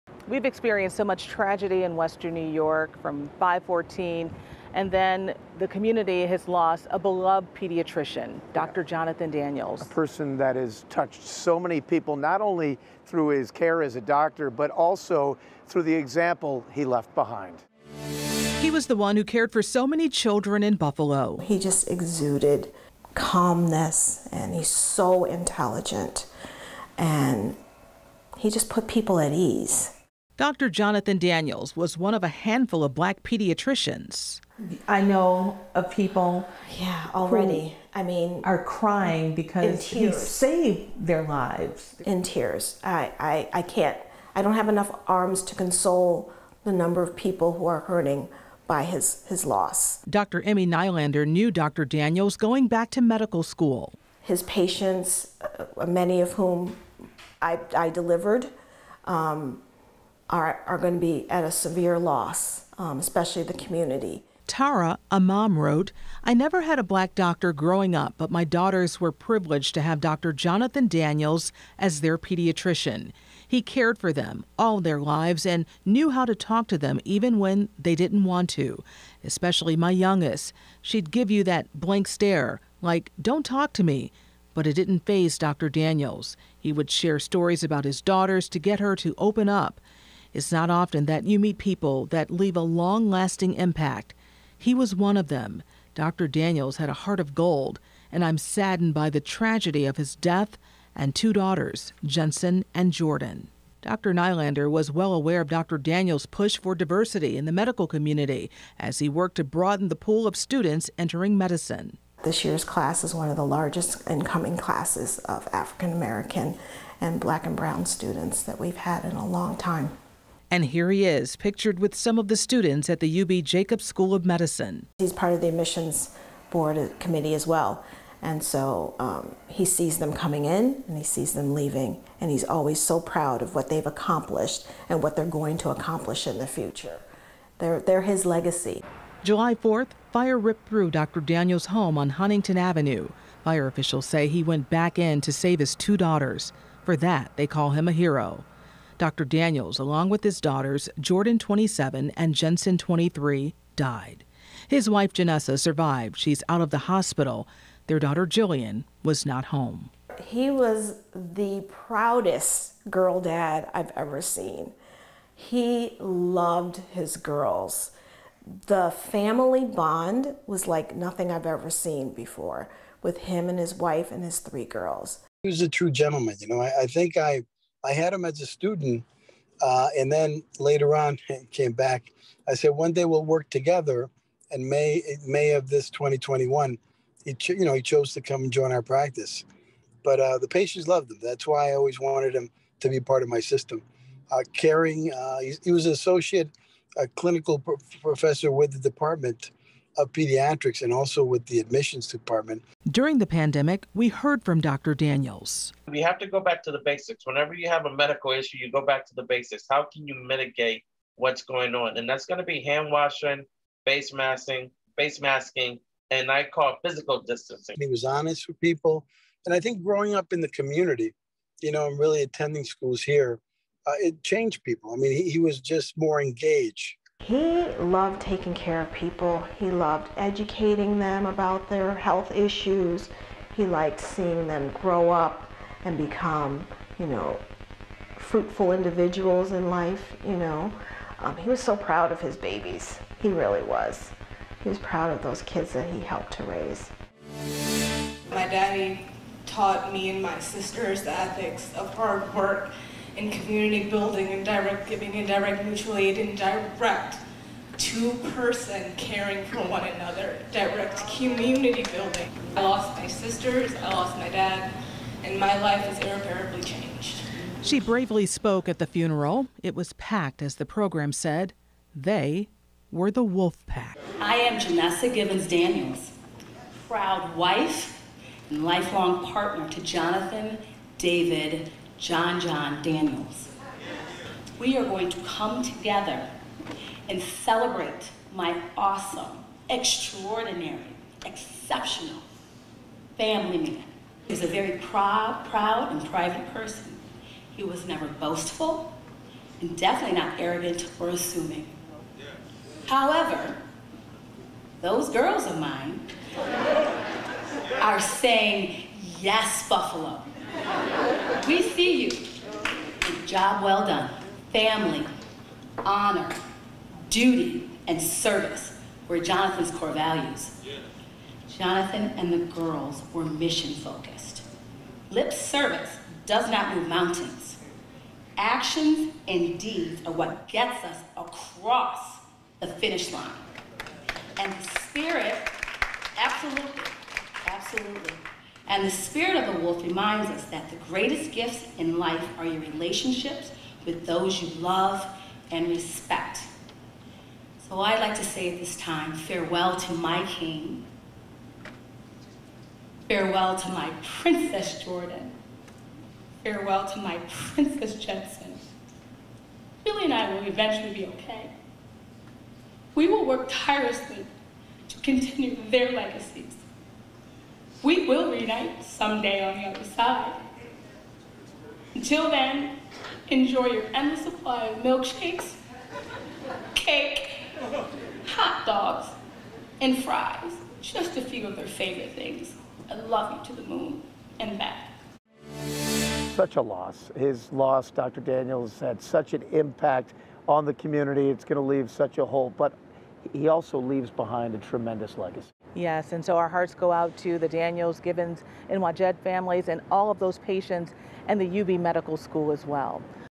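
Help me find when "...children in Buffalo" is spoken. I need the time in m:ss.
0:20.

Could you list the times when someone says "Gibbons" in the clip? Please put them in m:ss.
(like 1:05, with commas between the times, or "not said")
4:35, 6:38.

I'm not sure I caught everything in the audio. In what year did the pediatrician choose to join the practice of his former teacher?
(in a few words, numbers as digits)
2021.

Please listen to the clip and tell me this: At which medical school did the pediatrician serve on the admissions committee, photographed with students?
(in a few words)
UB Jacobs School of Medicine.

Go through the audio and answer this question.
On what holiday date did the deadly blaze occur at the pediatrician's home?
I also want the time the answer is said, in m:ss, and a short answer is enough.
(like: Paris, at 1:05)
July 4th, at 2:19.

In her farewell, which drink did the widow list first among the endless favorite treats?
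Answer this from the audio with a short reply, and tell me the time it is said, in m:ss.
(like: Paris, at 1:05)
milkshakes, at 6:14.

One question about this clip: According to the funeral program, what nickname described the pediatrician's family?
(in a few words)
Wolf Pack.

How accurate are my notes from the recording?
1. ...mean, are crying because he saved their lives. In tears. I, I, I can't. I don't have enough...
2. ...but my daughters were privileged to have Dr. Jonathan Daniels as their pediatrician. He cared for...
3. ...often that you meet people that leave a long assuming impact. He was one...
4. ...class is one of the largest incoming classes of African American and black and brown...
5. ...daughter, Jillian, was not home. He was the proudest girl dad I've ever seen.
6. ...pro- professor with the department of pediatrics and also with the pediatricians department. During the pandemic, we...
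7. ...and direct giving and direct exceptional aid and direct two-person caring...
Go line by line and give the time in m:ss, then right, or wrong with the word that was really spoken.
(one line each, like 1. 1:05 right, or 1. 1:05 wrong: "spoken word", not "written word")
1. 0:38 right
2. 1:08 right
3. 1:30 wrong: "lasting", not "assuming"
4. 1:52 right
5. 2:37 right
6. 3:17 wrong: "admissions", not "pediatricians"
7. 4:14 wrong: "mutual", not "exceptional".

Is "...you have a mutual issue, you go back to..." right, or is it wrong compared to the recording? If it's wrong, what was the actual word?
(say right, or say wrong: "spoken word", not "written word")
wrong: "medical", not "mutual".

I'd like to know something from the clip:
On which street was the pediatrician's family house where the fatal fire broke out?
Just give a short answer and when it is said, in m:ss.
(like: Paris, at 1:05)
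Huntington Avenue, at 2:22.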